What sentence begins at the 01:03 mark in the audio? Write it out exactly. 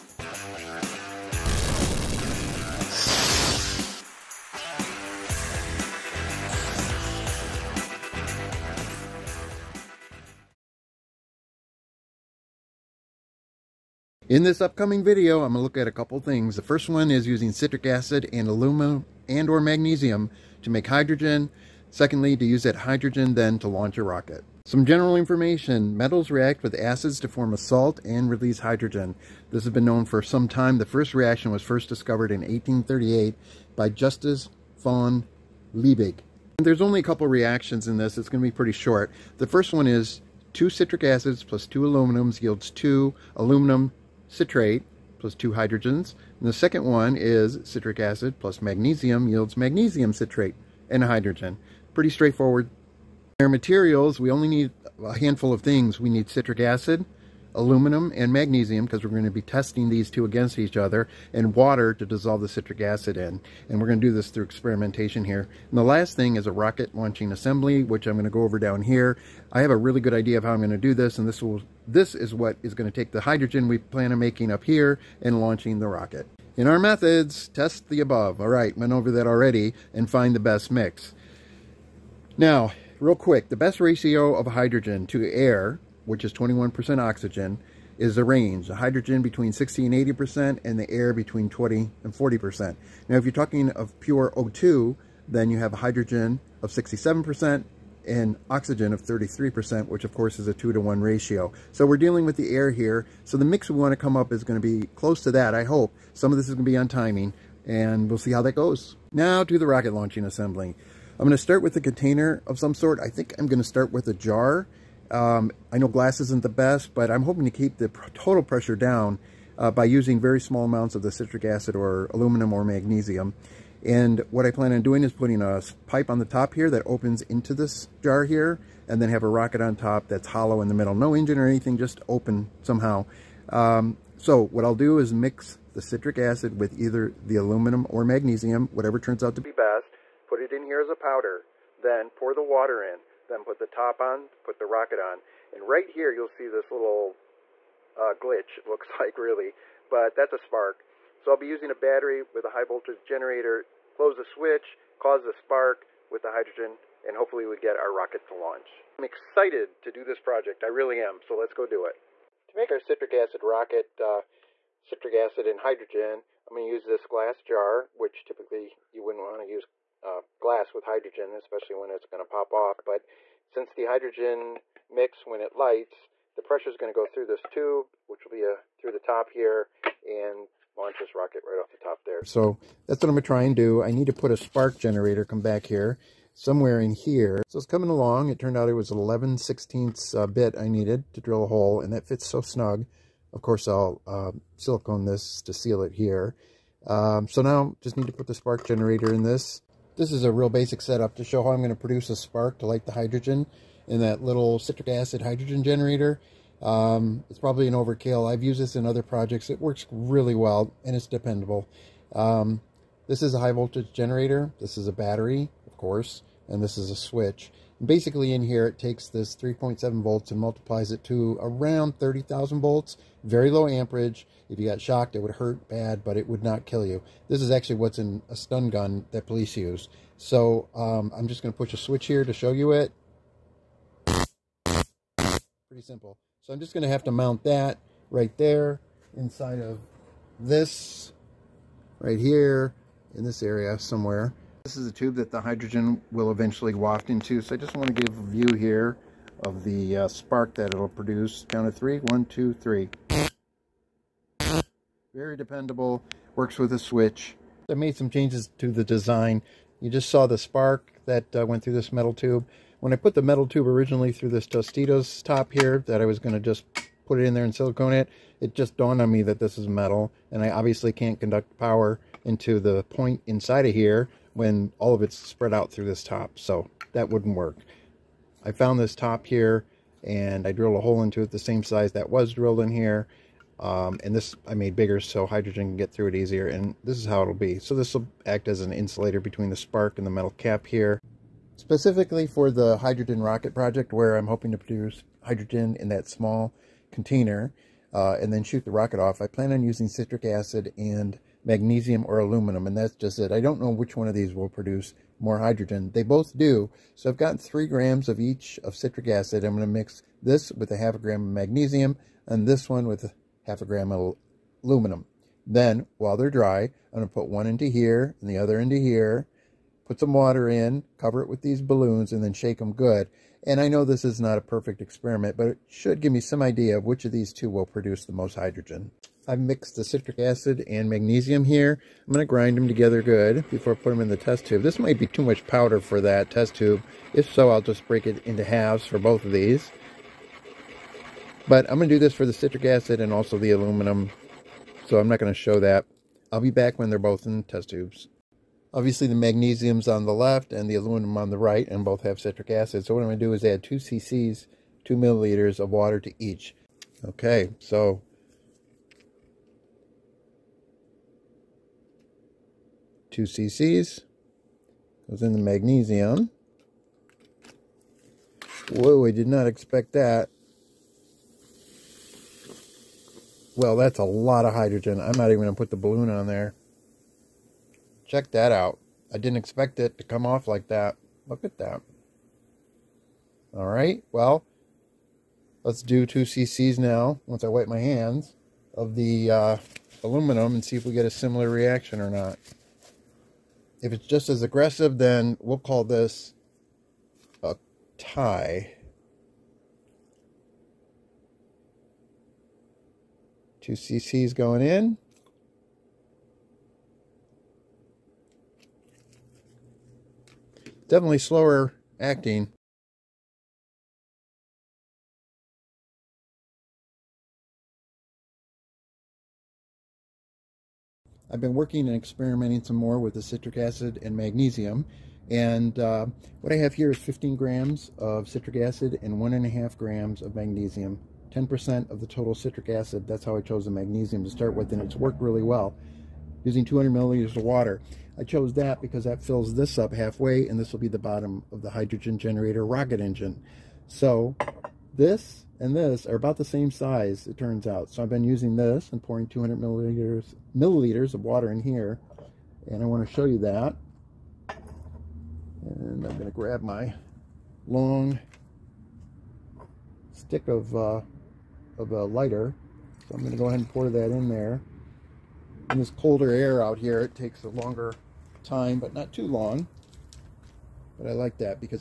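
And we're going to do this through experimentation here.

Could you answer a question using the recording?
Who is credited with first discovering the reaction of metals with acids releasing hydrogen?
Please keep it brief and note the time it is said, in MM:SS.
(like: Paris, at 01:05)
Justus von Liebig, at 00:33.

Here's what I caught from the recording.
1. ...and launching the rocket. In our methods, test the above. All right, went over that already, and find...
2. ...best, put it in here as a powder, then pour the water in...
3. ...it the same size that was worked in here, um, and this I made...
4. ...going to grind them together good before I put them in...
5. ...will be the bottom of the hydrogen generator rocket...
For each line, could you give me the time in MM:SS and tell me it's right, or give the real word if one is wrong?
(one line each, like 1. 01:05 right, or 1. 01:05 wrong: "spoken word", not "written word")
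1. 01:15 right
2. 02:19 right
3. 04:41 wrong: "drilled", not "worked"
4. 05:32 right
5. 07:20 right.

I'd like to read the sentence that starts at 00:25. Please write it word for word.
Metals react with acids to form a salt and release hydrogen.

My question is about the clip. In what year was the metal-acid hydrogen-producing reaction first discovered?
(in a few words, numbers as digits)
1838.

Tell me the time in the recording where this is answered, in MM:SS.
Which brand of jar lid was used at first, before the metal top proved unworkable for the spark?
04:24.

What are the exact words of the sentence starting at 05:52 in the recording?
So what I'm going to do is add 2 cc's, 2 milliliters of water to each.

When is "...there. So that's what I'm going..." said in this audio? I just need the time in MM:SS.
03:02.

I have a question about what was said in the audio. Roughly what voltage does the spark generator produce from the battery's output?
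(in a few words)
30,000 volts.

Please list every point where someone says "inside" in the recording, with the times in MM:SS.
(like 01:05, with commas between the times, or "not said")
03:59, 04:33.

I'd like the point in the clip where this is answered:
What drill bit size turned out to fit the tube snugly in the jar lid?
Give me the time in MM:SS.
03:08.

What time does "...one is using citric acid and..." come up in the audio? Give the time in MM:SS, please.
00:16.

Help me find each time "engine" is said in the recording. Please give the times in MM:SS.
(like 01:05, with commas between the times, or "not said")
02:11, 07:23.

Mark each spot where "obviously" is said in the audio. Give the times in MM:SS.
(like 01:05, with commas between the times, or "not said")
04:30, 05:48.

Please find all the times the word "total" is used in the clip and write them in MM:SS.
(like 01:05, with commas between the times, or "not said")
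01:58, 07:12.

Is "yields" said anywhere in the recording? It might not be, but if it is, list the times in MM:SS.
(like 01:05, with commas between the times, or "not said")
00:42, 00:49.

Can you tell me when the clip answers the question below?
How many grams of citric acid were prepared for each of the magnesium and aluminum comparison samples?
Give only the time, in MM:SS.
05:07.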